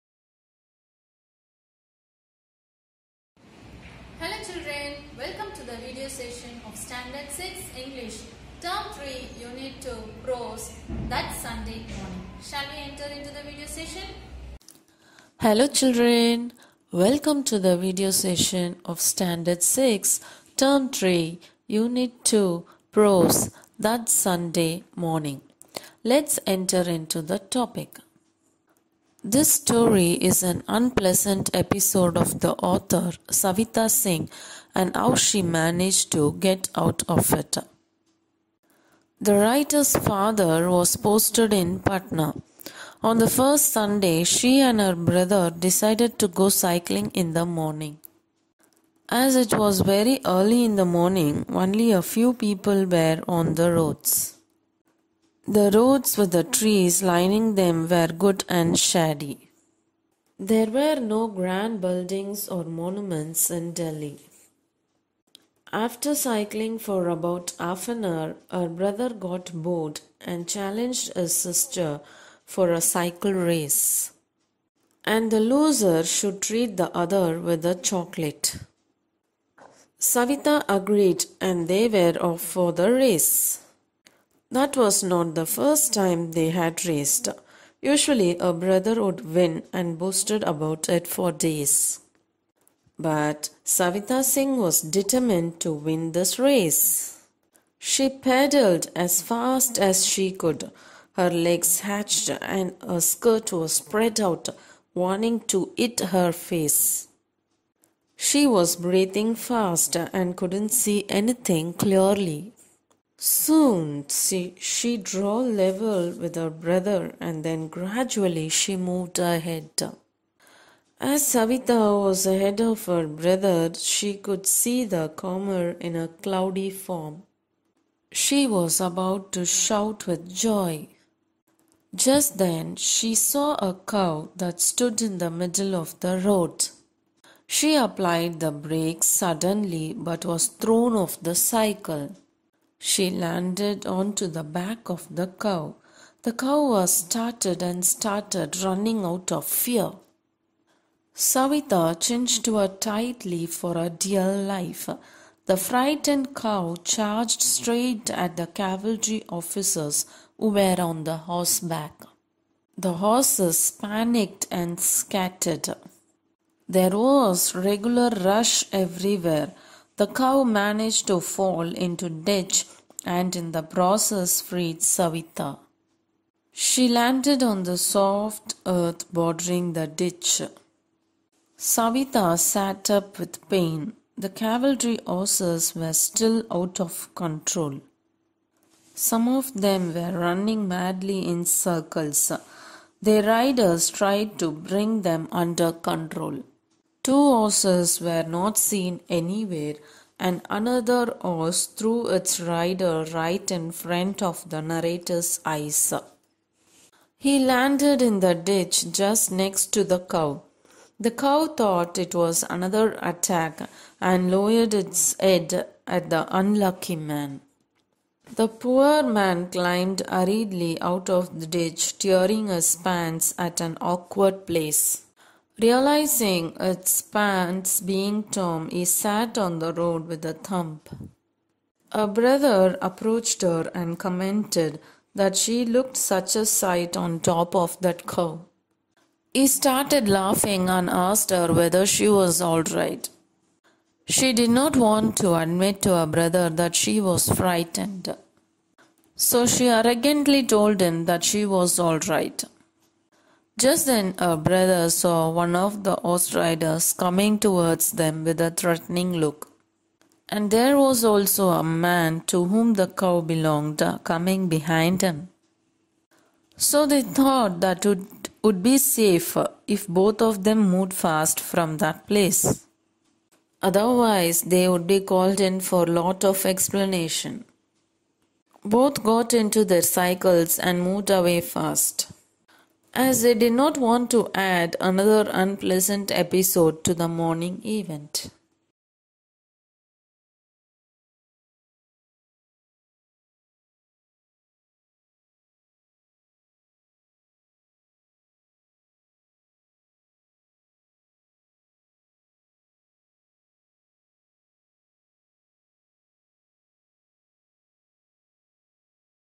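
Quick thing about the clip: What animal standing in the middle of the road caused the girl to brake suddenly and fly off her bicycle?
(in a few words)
A cow.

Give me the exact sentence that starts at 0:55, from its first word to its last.
The roads with the trees lining them were good and shady.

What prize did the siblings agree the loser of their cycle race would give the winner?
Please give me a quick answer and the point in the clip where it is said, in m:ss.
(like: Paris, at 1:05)
A chocolate, at 1:17.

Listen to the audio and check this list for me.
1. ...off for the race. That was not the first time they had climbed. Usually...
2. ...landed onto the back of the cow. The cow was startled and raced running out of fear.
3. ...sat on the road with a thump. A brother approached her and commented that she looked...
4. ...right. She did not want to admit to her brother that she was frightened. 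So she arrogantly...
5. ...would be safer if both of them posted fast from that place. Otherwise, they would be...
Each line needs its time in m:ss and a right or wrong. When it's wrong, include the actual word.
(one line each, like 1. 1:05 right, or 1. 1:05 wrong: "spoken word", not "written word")
1. 1:22 wrong: "raced", not "climbed"
2. 2:23 wrong: "started", not "raced"
3. 3:48 right
4. 4:02 right
5. 4:28 wrong: "moved", not "posted".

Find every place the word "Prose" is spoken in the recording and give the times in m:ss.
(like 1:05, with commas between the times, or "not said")
0:10, 0:22.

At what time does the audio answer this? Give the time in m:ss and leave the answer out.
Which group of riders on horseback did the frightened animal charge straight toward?
2:38.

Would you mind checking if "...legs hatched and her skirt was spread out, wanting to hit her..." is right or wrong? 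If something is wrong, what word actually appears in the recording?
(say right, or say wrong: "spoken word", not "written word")
right.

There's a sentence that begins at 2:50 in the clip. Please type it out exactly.
The cow managed to fall into ditch and in the process freed Savita.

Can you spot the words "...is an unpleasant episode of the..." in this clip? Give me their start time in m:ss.
0:30.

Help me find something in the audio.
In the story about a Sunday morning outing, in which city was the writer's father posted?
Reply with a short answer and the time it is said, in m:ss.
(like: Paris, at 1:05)
Patna, at 0:41.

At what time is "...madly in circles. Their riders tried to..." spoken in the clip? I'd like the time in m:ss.
3:10.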